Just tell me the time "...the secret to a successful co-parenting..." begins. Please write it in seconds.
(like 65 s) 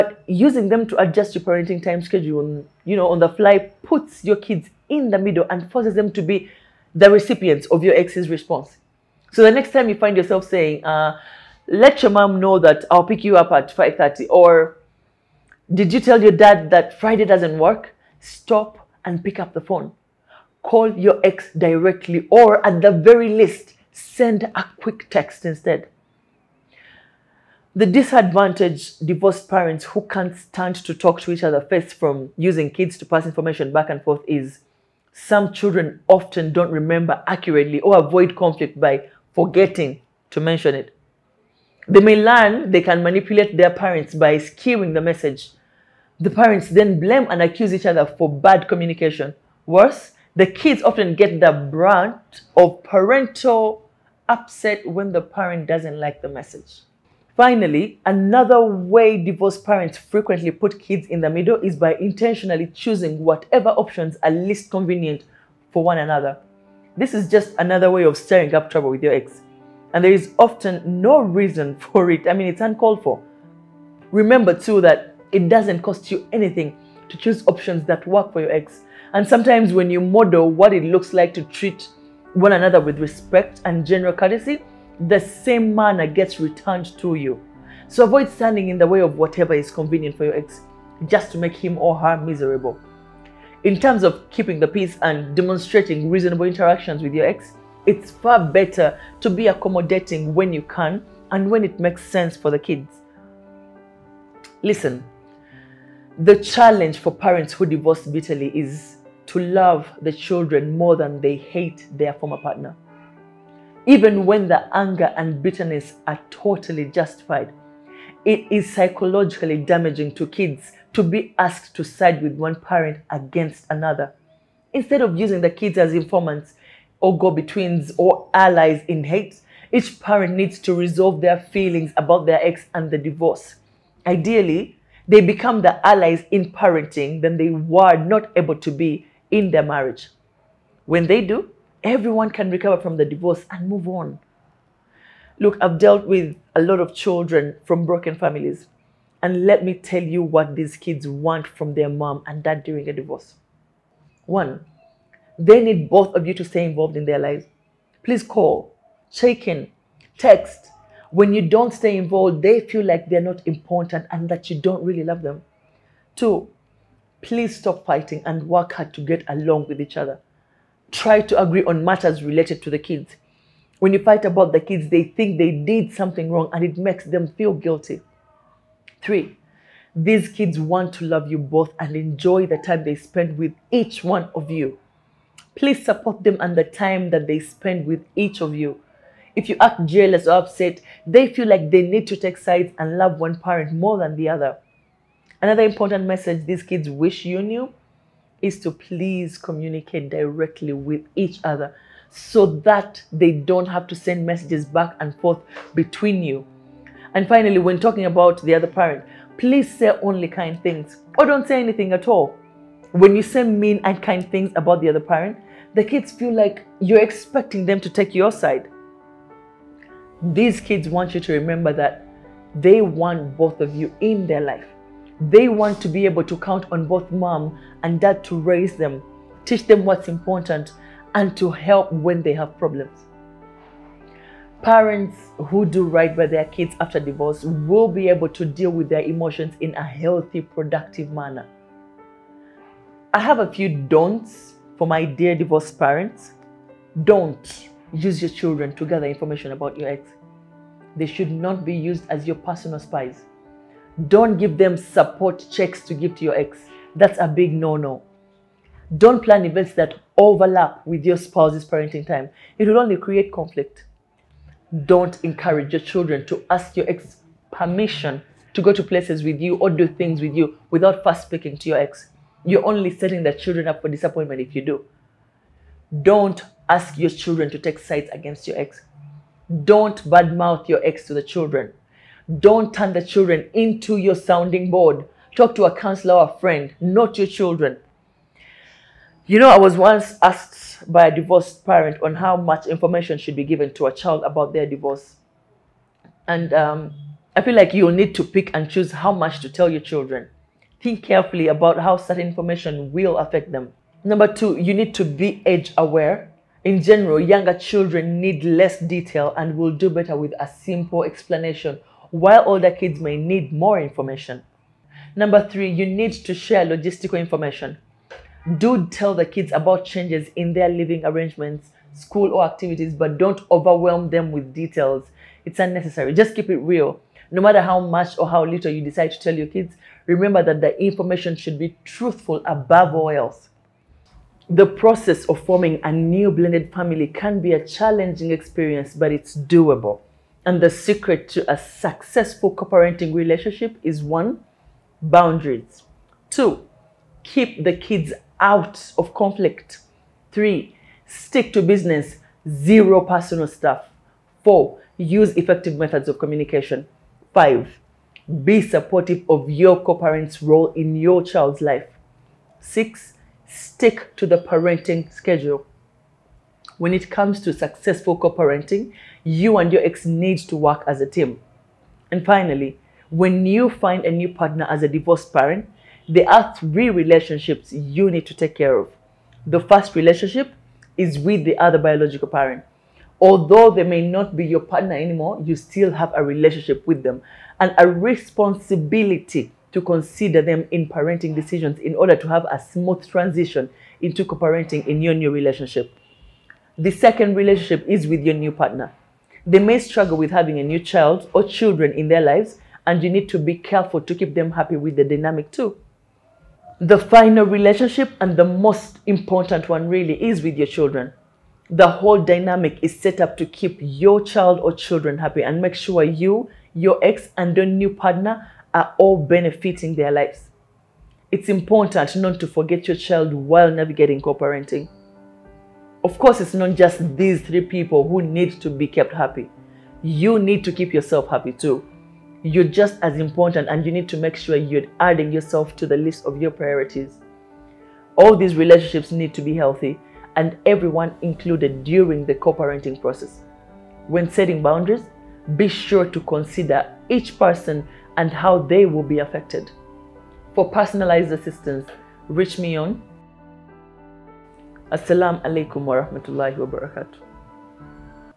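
340 s.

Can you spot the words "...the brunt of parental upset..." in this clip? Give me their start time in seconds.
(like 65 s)
51 s.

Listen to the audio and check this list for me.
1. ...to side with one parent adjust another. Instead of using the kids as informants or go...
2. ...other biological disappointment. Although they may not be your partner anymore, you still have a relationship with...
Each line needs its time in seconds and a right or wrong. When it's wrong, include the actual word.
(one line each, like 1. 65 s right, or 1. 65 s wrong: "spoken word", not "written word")
1. 121 s wrong: "against", not "adjust"
2. 381 s wrong: "parent", not "disappointment".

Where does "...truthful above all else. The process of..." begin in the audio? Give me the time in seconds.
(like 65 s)
331 s.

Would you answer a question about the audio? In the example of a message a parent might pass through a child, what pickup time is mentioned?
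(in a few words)
5:30.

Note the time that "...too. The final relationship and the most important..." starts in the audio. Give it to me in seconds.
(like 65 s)
405 s.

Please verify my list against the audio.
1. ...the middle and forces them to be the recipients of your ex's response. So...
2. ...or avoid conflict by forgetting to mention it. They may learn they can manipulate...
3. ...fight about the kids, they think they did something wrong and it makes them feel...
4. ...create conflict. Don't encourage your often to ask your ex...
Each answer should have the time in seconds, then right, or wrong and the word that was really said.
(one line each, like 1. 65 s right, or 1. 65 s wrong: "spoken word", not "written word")
1. 5 s right
2. 37 s right
3. 173 s right
4. 262 s wrong: "children", not "often".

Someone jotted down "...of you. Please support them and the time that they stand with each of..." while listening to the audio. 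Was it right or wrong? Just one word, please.
wrong.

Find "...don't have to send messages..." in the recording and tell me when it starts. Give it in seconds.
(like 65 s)
203 s.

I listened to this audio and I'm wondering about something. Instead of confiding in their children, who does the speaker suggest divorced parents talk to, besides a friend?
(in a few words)
a counselor.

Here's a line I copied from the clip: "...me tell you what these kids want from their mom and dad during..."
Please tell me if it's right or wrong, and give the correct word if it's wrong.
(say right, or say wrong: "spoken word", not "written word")
right.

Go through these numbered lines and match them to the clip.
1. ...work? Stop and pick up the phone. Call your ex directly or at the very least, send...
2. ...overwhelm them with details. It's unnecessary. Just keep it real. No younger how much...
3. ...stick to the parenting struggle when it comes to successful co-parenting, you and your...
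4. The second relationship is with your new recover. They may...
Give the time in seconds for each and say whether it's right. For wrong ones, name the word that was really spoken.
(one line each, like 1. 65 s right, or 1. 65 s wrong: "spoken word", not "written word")
1. 17 s right
2. 323 s wrong: "matter", not "younger"
3. 363 s wrong: "schedule", not "struggle"
4. 396 s wrong: "partner", not "recover".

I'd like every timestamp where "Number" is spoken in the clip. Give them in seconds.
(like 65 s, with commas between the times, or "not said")
304 s, 315 s.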